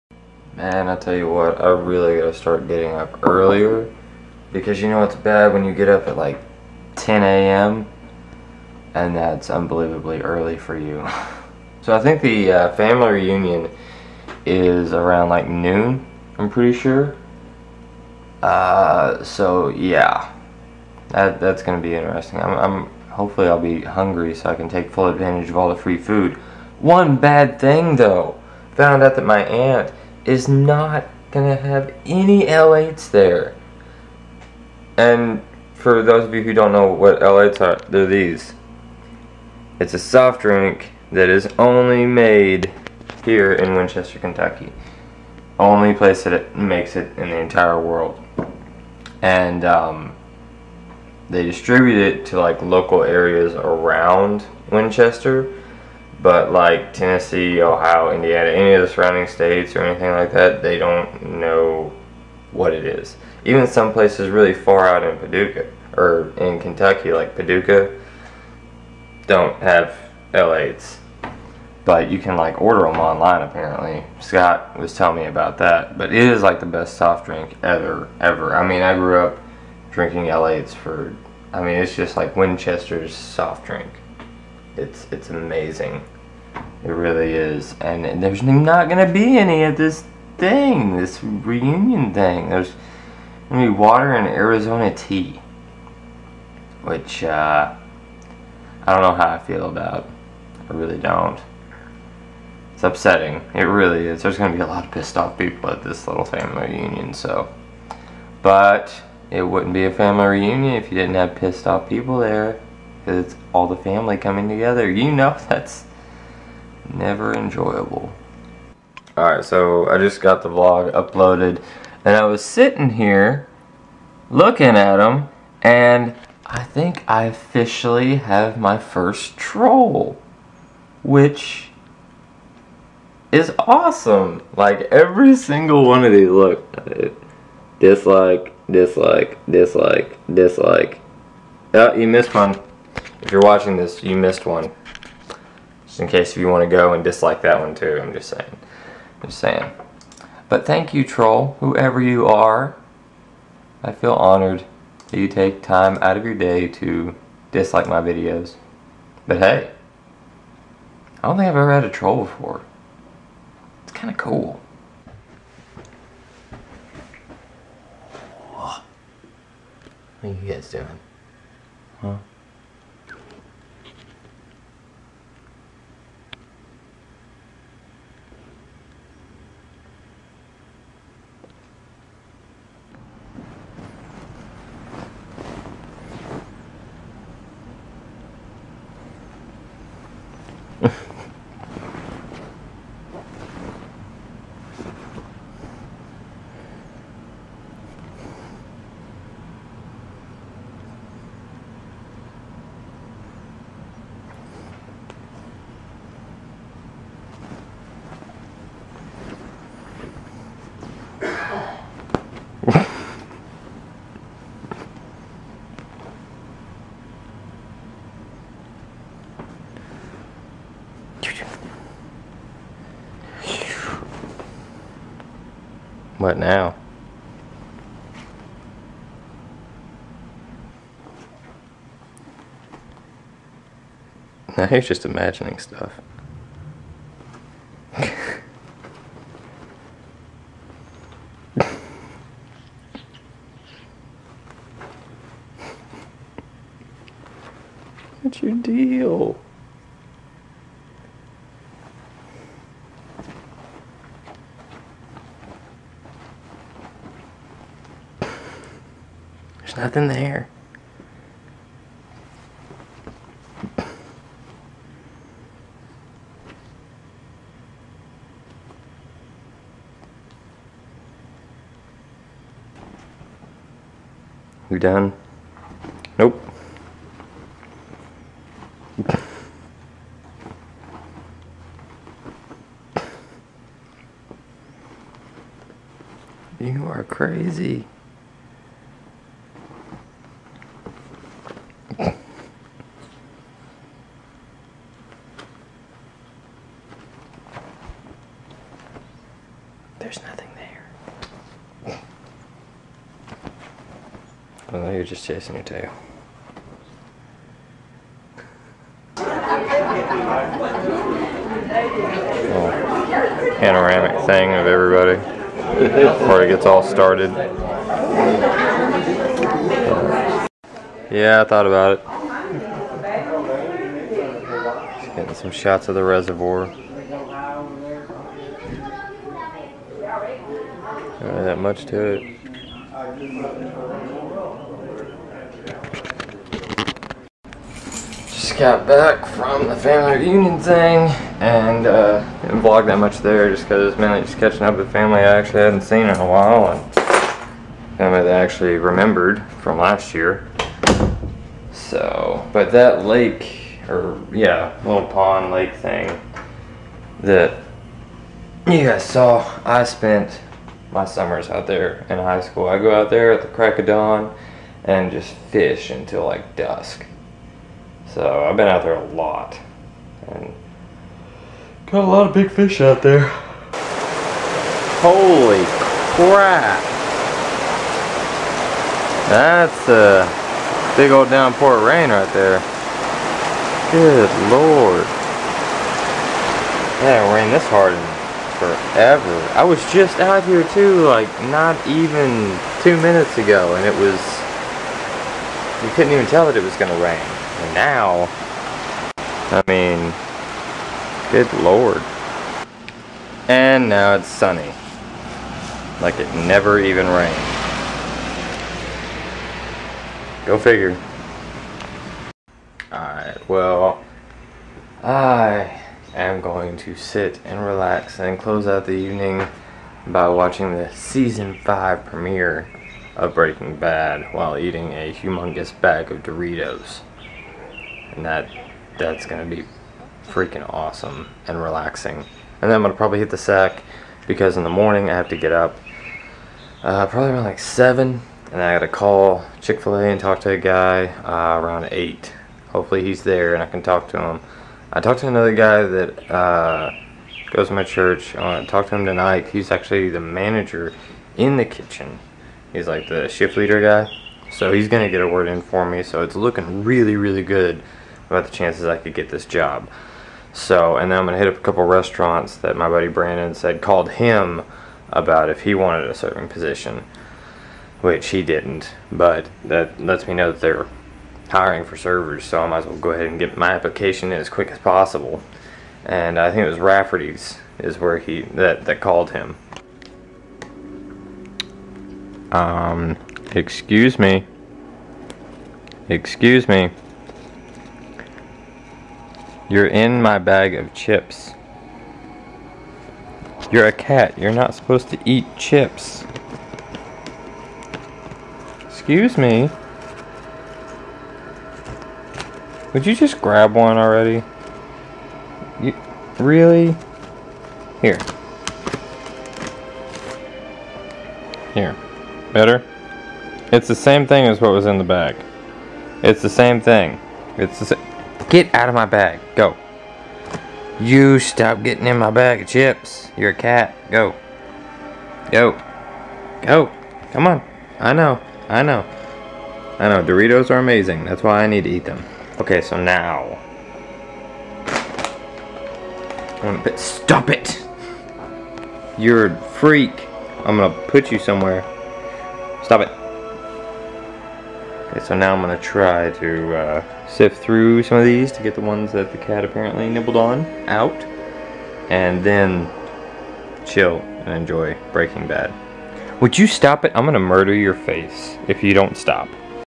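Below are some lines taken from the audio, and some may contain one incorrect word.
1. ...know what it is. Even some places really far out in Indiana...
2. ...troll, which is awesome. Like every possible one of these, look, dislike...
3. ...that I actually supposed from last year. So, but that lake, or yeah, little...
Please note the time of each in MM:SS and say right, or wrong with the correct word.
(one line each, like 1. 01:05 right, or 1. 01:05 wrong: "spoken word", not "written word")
1. 01:01 wrong: "Paducah", not "Indiana"
2. 02:09 wrong: "single", not "possible"
3. 05:48 wrong: "remembered", not "supposed".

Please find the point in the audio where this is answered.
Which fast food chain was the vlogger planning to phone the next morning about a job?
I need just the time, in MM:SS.
07:19.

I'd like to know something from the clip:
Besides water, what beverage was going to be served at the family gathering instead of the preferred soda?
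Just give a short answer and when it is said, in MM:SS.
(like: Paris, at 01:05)
Arizona tea, at 01:34.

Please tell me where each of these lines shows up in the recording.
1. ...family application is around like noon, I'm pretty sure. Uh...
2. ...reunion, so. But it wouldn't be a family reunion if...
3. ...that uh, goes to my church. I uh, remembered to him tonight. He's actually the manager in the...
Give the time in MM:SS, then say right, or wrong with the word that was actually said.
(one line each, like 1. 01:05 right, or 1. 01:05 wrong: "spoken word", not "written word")
1. 00:12 wrong: "reunion", not "application"
2. 01:46 right
3. 07:25 wrong: "talked", not "remembered".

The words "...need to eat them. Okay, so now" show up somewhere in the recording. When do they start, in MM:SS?
08:51.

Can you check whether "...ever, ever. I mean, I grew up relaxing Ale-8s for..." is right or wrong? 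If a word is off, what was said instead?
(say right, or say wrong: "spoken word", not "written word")
wrong: "drinking", not "relaxing".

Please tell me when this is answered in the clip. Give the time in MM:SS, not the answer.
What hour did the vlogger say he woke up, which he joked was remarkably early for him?
00:06.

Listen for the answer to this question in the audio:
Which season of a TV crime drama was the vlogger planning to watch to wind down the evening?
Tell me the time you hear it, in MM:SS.
07:01.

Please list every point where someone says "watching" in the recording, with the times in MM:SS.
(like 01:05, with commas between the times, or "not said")
02:23, 07:00.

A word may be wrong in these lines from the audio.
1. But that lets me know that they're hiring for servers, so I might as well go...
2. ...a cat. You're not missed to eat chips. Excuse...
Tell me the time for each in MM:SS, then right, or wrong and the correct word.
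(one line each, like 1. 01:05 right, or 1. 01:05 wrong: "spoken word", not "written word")
1. 07:49 right
2. 08:13 wrong: "supposed", not "missed".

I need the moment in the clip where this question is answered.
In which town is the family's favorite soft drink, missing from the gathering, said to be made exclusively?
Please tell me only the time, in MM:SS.
00:43.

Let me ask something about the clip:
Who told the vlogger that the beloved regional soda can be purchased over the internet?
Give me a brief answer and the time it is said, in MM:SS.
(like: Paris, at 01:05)
Scott, at 01:14.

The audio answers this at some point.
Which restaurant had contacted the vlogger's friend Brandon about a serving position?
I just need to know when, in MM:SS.
07:56.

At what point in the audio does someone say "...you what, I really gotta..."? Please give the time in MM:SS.
00:01.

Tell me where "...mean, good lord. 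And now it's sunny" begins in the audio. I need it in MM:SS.
06:39.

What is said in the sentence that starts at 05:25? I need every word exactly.
Just getting some shots of the reservoir.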